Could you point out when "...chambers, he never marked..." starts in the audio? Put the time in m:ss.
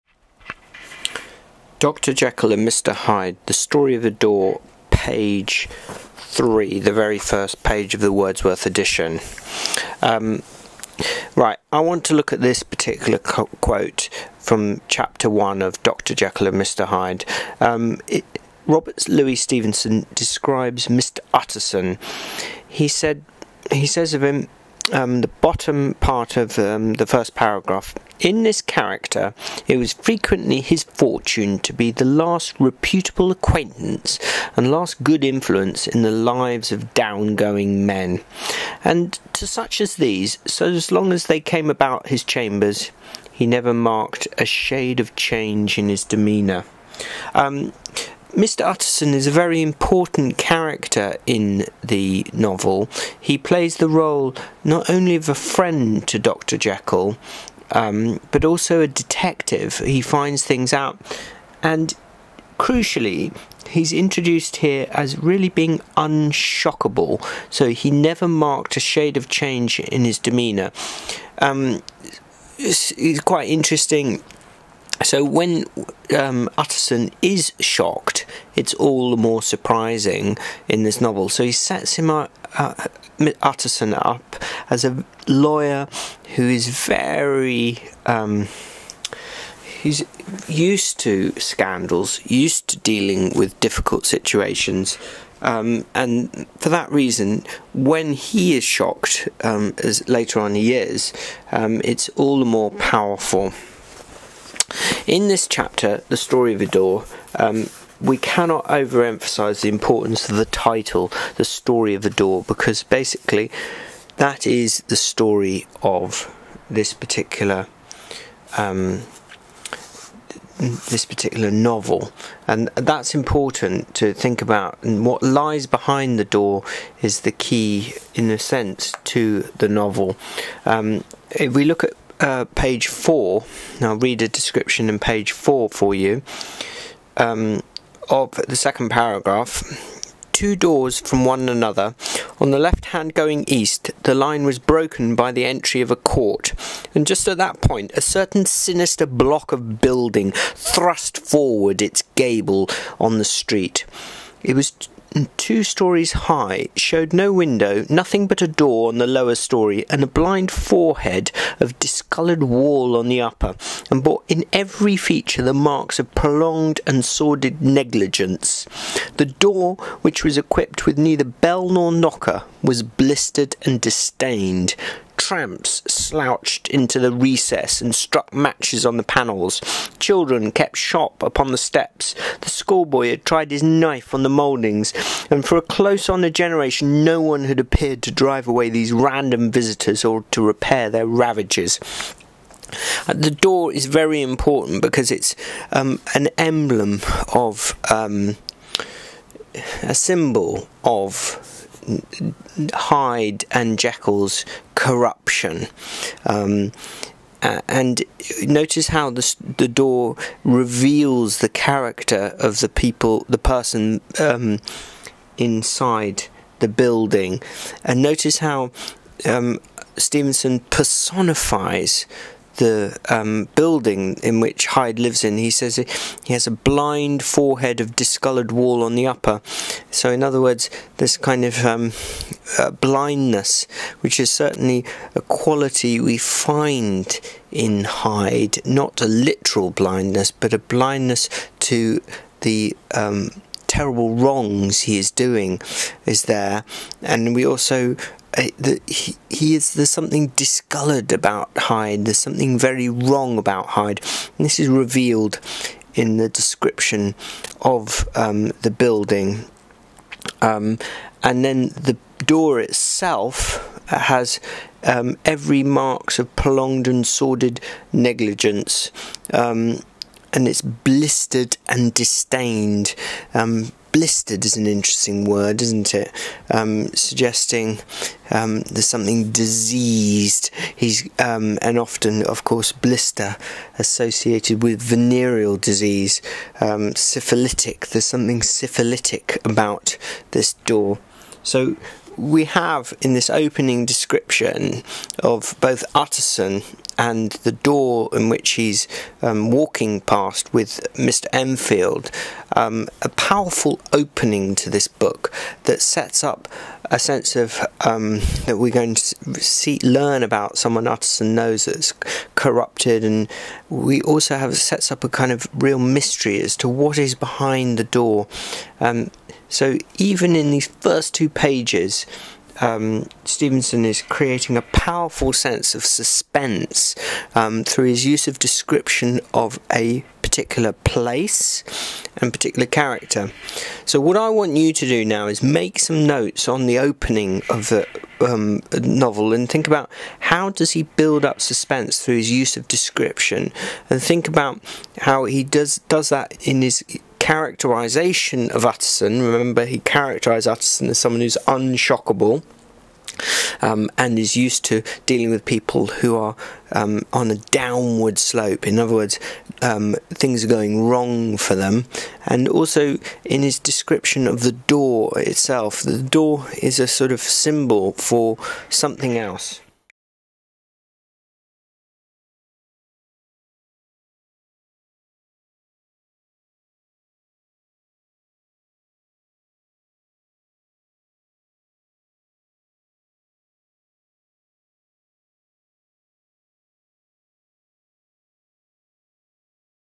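0:42.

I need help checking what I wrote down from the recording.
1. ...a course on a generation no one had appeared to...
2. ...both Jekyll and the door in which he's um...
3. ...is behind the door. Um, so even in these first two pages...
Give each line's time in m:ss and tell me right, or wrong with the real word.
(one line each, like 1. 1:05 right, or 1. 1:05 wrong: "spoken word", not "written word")
1. 3:05 wrong: "close", not "course"
2. 4:55 wrong: "Utterson", not "Jekyll"
3. 5:16 right.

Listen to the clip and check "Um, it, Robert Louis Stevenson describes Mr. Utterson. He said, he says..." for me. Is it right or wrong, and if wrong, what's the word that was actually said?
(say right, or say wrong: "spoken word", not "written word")
right.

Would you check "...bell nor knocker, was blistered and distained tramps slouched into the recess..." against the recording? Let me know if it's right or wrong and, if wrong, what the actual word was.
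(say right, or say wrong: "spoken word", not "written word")
right.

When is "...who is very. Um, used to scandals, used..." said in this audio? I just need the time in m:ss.
1:26.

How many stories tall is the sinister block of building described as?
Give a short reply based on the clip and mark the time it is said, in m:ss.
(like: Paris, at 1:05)
2, at 2:35.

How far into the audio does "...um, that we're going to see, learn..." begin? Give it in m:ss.
5:07.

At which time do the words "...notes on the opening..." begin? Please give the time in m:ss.
5:36.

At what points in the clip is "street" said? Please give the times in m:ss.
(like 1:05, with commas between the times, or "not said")
2:33.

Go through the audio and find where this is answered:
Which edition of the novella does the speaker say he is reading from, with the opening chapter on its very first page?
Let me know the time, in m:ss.
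0:08.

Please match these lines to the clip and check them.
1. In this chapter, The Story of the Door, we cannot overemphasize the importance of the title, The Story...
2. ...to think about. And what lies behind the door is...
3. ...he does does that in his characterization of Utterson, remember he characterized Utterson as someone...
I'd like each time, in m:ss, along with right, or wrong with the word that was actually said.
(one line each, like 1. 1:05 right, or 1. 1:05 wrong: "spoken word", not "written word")
1. 1:45 right
2. 2:03 right
3. 5:45 right.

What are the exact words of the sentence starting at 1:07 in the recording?
So he never marked a shade of change in his demeanour.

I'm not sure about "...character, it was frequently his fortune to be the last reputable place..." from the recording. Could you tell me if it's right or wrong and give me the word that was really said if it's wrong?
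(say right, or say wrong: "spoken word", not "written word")
wrong: "acquaintance", not "place".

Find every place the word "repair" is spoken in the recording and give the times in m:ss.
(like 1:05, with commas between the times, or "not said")
3:10.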